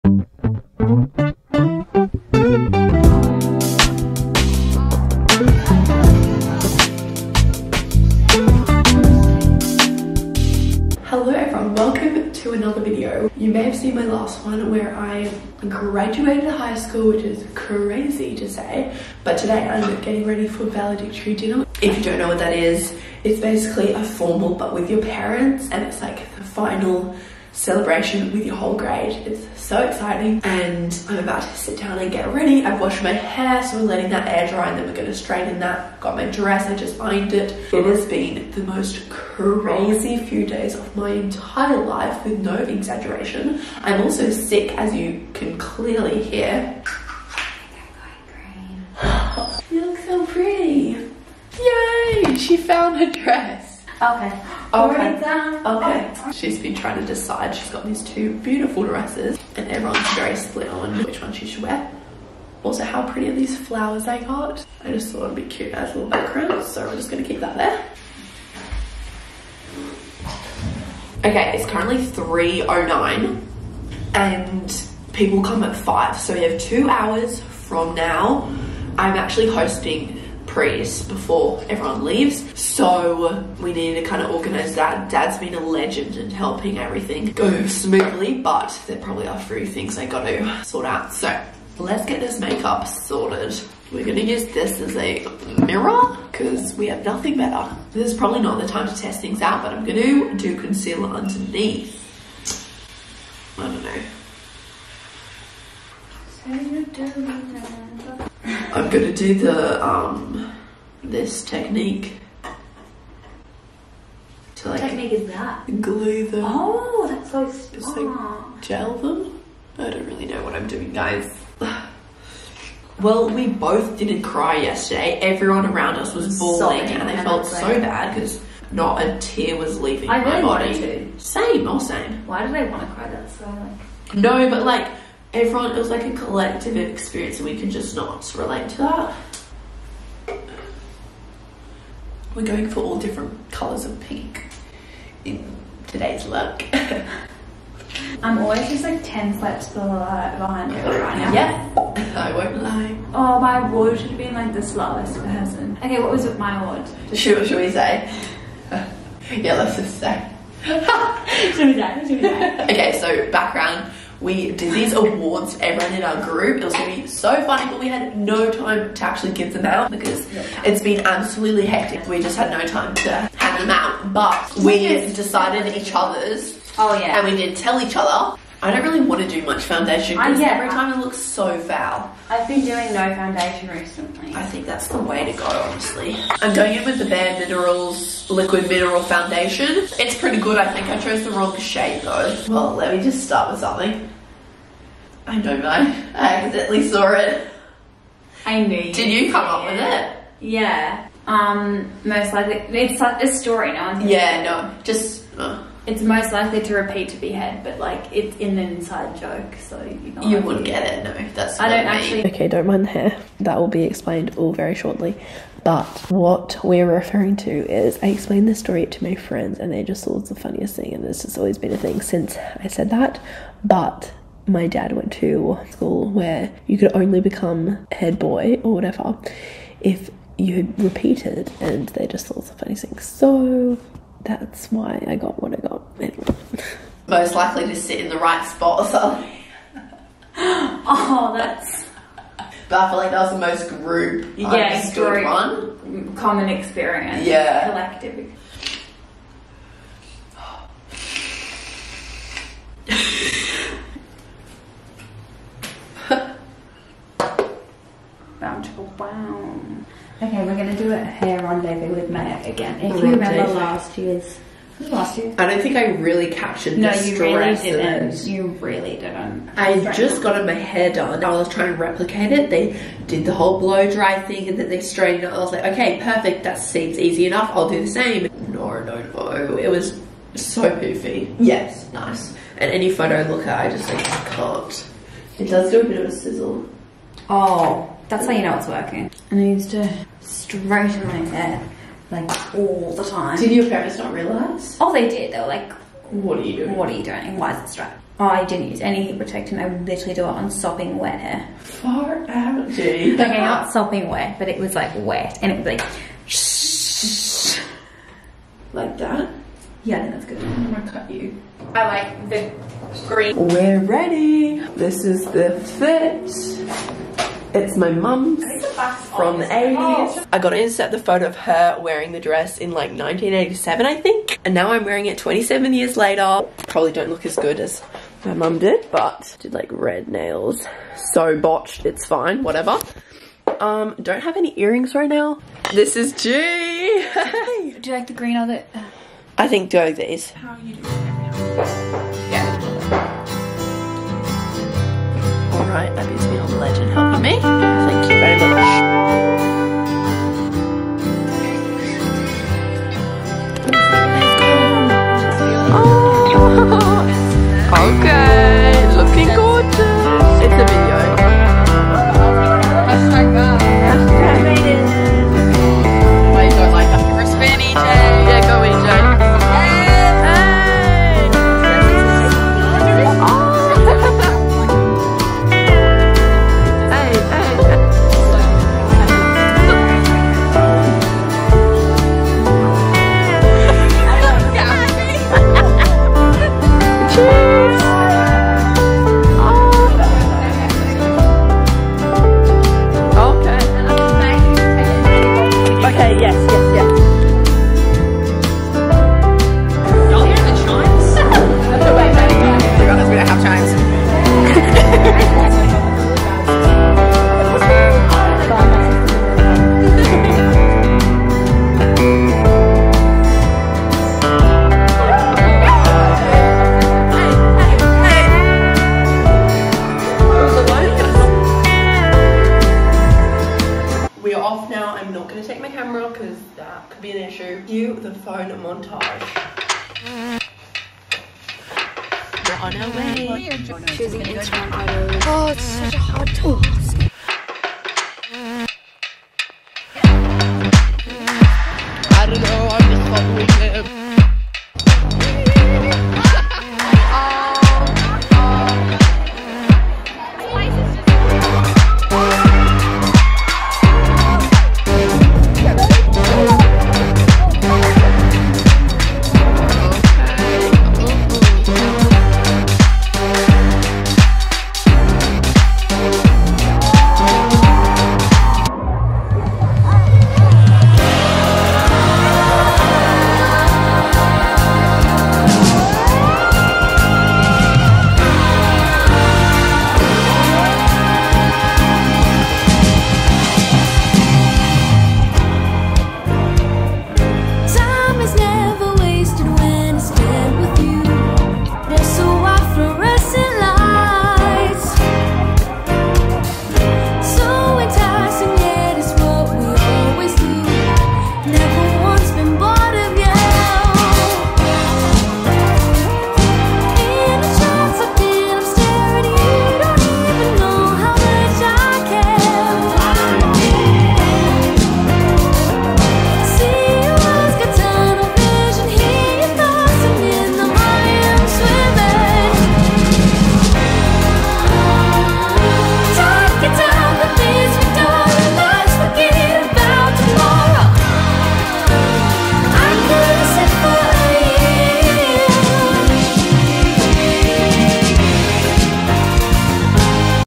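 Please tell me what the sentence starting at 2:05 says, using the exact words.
Everyone around us was bawling and they felt so bad because not a tear was leaving I my really body.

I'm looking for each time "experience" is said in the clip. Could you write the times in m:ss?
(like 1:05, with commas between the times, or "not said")
2:16, 4:06.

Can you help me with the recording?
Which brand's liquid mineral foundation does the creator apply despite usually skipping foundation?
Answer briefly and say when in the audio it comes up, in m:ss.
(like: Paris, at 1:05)
Bare Minerals, at 3:07.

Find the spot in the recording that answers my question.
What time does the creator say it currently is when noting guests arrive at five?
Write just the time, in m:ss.
1:11.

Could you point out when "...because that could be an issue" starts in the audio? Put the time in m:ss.
7:06.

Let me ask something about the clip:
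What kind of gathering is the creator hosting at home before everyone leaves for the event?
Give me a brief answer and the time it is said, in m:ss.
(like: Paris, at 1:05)
Praise, at 1:20.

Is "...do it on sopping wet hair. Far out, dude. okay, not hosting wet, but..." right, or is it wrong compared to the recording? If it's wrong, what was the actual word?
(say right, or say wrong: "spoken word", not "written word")
wrong: "sopping", not "hosting".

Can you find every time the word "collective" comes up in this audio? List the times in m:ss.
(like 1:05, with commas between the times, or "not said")
2:16, 4:07.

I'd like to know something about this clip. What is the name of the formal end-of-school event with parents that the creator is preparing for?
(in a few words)
Valedictory dinner.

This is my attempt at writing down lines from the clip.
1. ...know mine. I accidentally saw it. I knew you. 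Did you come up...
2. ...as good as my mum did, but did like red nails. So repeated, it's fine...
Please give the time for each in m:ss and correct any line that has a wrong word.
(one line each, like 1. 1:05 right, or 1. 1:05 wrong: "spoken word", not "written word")
1. 3:15 right
2. 5:27 wrong: "botched", not "repeated".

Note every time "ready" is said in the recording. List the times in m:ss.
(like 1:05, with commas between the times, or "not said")
0:20, 0:32, 5:13.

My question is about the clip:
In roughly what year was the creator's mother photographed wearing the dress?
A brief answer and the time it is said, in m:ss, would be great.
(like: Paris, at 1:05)
1987, at 5:22.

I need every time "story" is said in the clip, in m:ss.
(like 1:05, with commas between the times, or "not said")
3:23, 3:38.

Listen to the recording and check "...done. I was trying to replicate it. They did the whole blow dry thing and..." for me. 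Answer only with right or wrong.
right.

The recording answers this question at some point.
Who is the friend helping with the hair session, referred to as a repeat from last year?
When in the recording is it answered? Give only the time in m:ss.
4:22.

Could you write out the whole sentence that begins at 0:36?
Got my dress, I just ironed it.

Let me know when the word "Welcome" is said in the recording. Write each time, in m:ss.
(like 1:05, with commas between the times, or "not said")
0:11.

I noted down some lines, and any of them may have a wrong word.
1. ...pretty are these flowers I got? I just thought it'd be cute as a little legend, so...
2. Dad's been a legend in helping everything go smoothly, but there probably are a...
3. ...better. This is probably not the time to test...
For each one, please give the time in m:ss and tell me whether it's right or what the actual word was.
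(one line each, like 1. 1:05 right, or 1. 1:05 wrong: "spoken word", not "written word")
1. 1:03 wrong: "background", not "legend"
2. 1:25 right
3. 1:37 right.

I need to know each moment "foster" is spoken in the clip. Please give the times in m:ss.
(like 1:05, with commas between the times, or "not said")
not said.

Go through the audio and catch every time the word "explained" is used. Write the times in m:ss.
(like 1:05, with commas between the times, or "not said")
3:33, 3:38.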